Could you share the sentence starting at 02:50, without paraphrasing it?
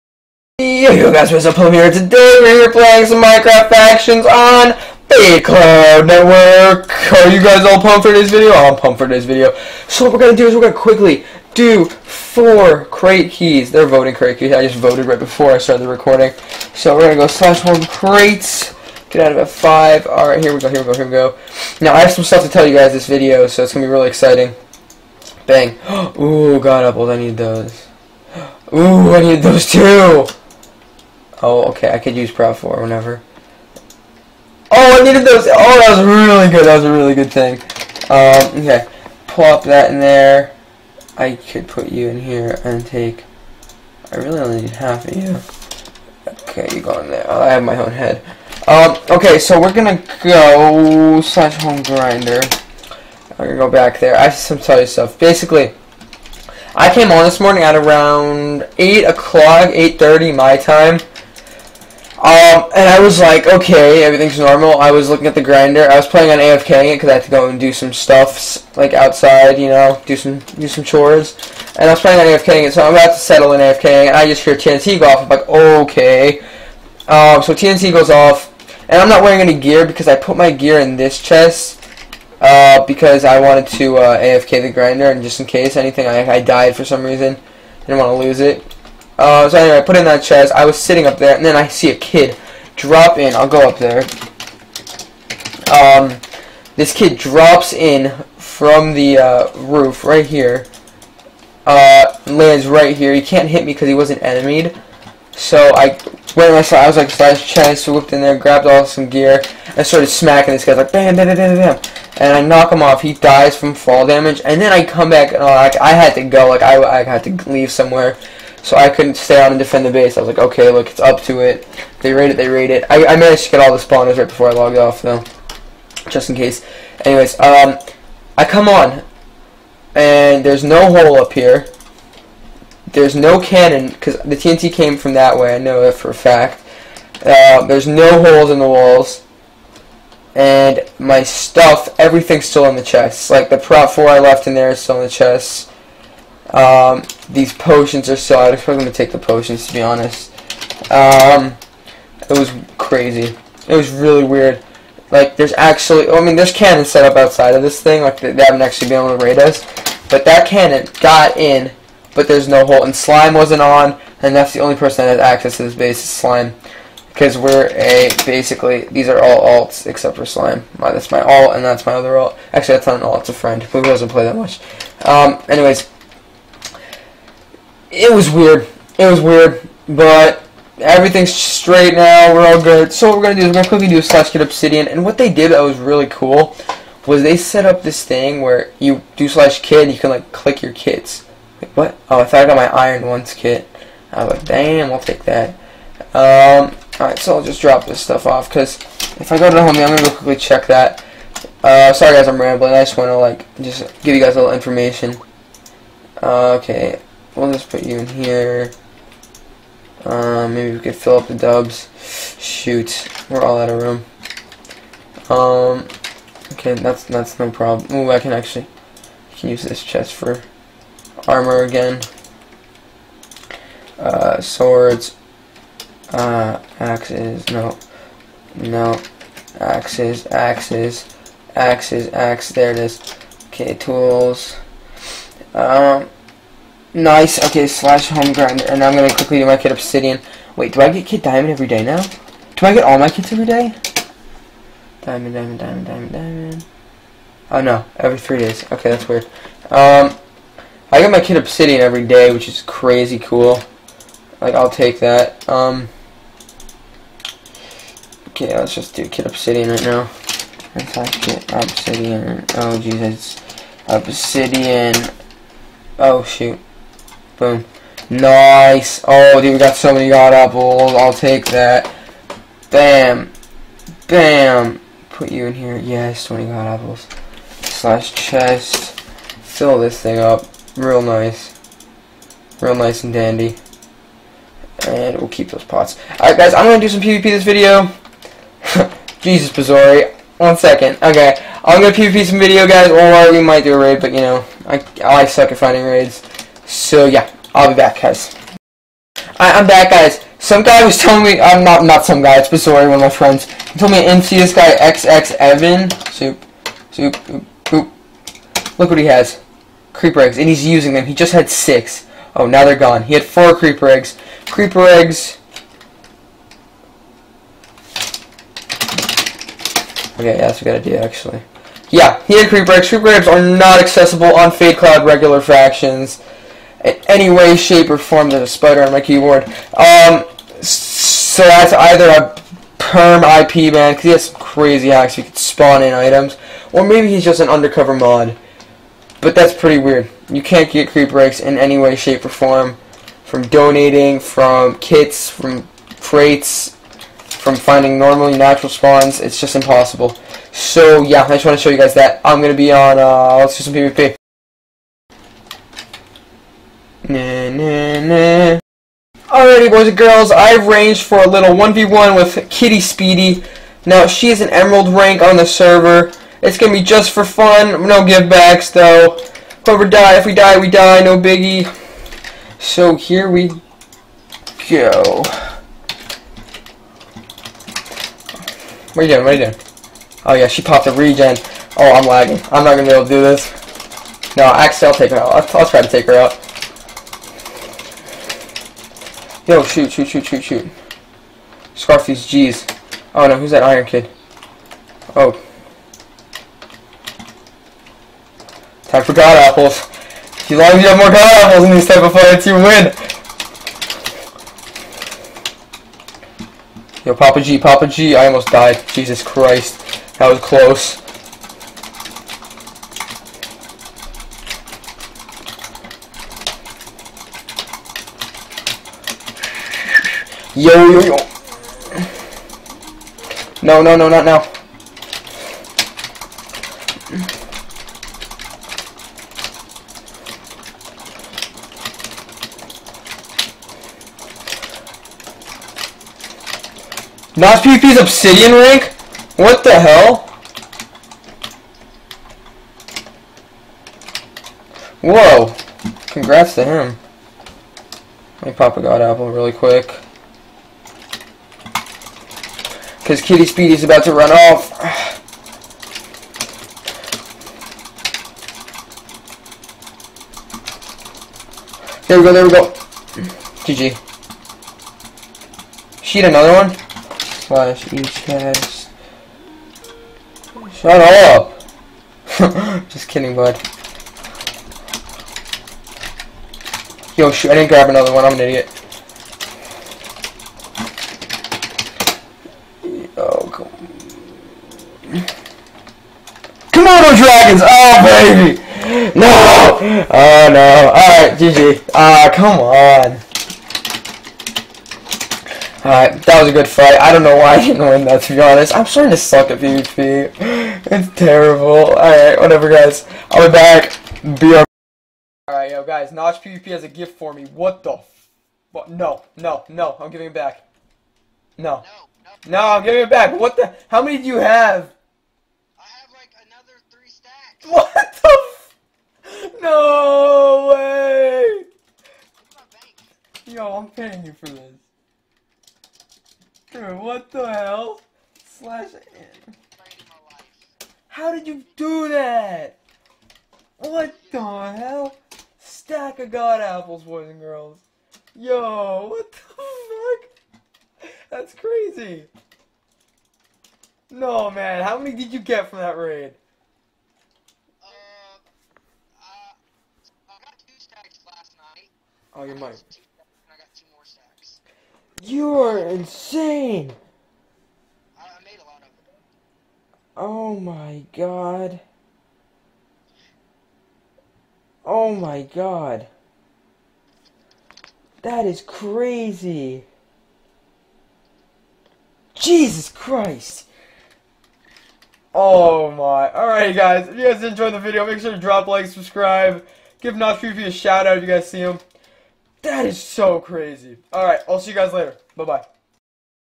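My, that's my alt, and that's my other alt.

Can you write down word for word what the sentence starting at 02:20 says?
And my stuff, everything's still in the chest.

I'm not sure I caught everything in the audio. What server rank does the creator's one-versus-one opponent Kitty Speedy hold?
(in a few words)
Emerald.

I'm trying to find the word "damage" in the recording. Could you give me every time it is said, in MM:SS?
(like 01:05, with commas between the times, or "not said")
01:54.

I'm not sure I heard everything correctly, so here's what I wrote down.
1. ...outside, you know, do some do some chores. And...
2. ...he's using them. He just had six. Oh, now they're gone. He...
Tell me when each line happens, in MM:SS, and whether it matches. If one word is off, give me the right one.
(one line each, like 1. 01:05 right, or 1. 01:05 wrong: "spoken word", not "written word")
1. 01:08 right
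2. 05:10 right.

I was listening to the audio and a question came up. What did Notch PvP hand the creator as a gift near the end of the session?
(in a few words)
Stack of god apples.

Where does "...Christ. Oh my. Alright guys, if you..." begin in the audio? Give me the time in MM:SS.
09:32.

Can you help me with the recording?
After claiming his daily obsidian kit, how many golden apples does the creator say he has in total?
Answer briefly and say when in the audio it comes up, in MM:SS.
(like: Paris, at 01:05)
20, at 04:36.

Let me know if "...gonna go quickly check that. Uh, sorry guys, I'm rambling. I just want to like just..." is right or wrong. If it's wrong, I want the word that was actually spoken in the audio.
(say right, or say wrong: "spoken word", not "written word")
right.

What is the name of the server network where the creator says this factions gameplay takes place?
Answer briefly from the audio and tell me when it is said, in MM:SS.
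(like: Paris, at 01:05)
Big Cloud Network, at 00:05.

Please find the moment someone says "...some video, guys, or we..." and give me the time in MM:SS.
04:52.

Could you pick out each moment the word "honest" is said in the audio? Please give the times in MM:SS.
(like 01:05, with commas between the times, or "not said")
02:29, 08:18.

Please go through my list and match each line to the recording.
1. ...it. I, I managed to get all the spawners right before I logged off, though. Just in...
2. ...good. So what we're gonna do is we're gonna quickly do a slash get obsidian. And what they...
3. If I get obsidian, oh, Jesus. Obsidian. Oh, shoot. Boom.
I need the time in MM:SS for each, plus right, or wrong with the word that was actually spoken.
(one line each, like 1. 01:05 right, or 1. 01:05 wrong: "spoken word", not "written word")
1. 02:02 right
2. 03:02 right
3. 04:20 right.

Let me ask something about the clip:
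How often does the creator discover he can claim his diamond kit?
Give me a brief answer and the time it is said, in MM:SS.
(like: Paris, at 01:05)
Every three days, at 04:07.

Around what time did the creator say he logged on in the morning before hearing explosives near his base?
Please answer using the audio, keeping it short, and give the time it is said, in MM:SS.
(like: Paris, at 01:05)
8 o'clock, at 00:58.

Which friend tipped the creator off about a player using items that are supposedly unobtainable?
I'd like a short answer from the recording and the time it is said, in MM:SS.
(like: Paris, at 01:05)
Bizarre, at 05:02.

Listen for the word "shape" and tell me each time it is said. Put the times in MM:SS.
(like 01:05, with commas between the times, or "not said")
05:27, 05:41.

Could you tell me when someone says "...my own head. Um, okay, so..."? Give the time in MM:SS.
00:47.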